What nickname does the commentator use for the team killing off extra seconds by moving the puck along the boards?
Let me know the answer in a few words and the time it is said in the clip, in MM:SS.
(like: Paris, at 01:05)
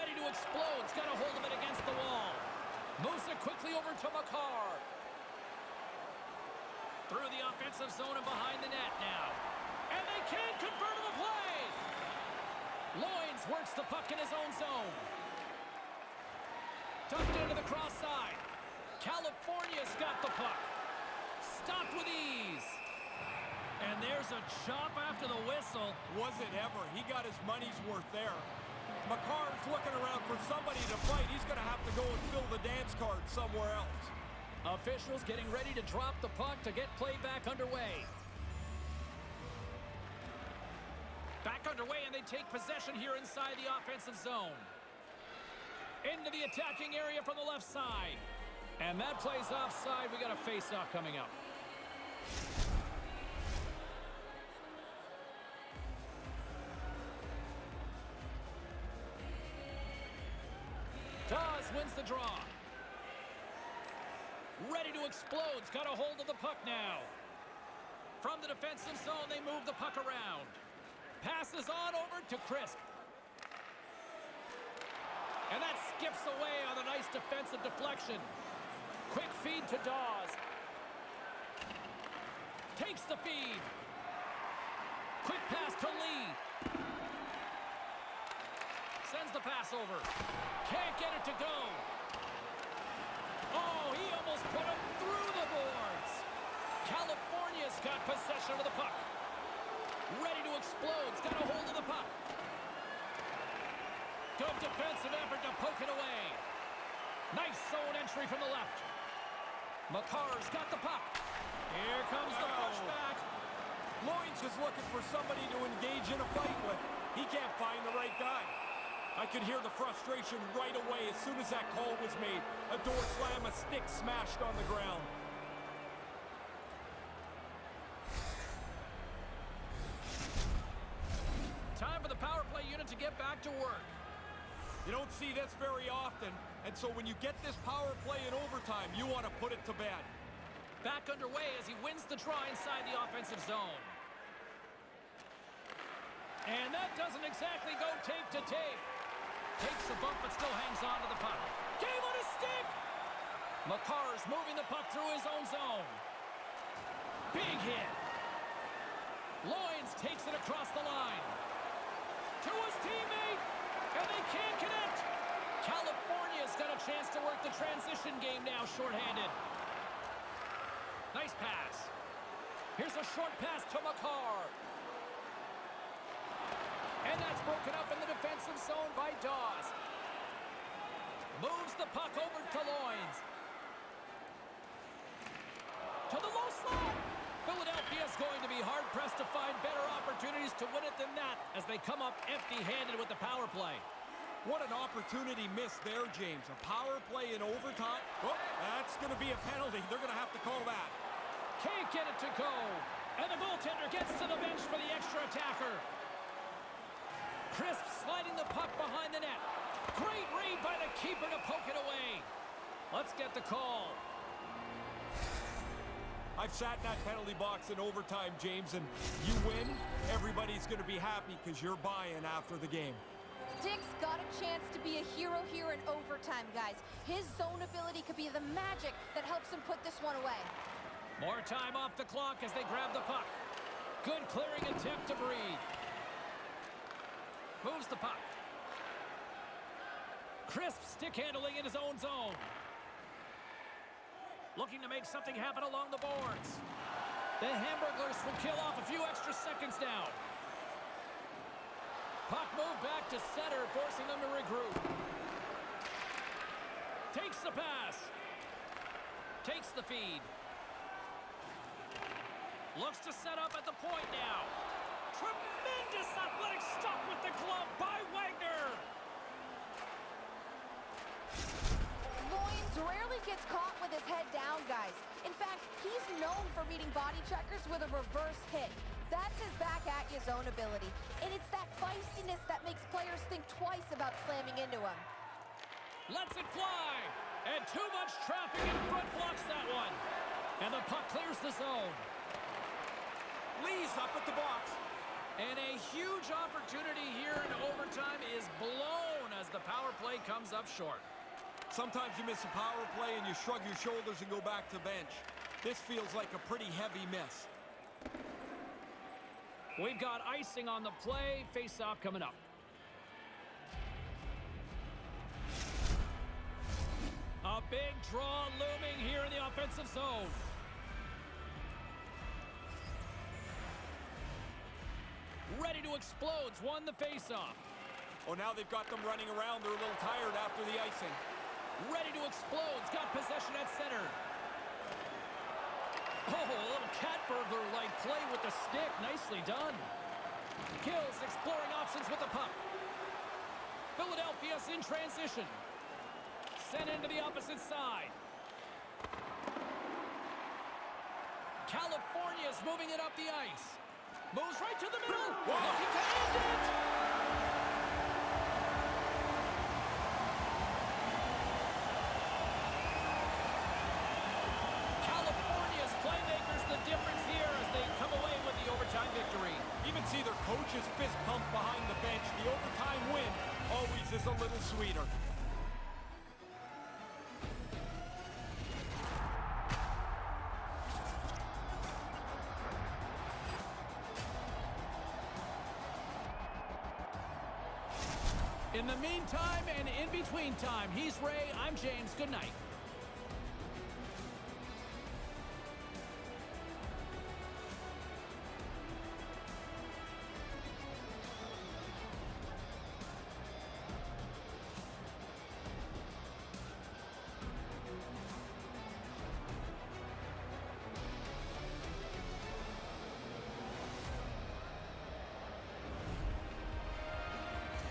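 The Hamburglars, at 04:07.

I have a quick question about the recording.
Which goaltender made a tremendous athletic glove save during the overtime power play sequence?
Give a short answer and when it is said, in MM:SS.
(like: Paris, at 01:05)
Wagner, at 04:28.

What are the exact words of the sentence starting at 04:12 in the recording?
Puck moved back to center, forcing them to regroup.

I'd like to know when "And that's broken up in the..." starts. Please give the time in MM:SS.
02:57.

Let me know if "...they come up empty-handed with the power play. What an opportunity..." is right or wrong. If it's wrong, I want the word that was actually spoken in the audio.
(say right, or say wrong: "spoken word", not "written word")
right.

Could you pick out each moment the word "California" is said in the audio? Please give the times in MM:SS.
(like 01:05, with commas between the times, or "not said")
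00:18, 01:36, 02:45, 05:51.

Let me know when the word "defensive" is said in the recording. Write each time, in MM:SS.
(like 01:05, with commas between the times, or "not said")
01:08, 01:17, 01:44, 02:58.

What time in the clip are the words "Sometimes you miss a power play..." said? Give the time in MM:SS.
05:01.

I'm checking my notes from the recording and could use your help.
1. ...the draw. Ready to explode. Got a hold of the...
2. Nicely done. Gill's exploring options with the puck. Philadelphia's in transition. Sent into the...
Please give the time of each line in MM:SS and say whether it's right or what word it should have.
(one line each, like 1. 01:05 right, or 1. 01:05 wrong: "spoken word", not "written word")
1. 01:01 right
2. 05:39 right.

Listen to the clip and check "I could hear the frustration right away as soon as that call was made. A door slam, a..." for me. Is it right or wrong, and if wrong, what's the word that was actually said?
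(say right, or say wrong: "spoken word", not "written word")
right.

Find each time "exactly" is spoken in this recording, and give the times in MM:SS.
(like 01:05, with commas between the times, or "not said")
02:27.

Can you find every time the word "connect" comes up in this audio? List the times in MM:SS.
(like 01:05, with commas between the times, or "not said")
02:44.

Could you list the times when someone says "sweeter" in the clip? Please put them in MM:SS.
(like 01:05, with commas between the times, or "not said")
06:14.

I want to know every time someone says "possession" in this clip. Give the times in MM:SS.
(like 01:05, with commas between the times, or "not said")
00:42, 01:38, 05:33.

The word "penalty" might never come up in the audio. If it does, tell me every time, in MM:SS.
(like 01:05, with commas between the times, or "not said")
03:19, 03:37.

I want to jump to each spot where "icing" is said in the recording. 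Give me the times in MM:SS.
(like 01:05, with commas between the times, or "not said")
05:10, 05:30.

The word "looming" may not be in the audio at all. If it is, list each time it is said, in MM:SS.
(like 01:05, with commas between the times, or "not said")
05:18.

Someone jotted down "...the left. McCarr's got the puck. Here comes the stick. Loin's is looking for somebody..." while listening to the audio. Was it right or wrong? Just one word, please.
wrong.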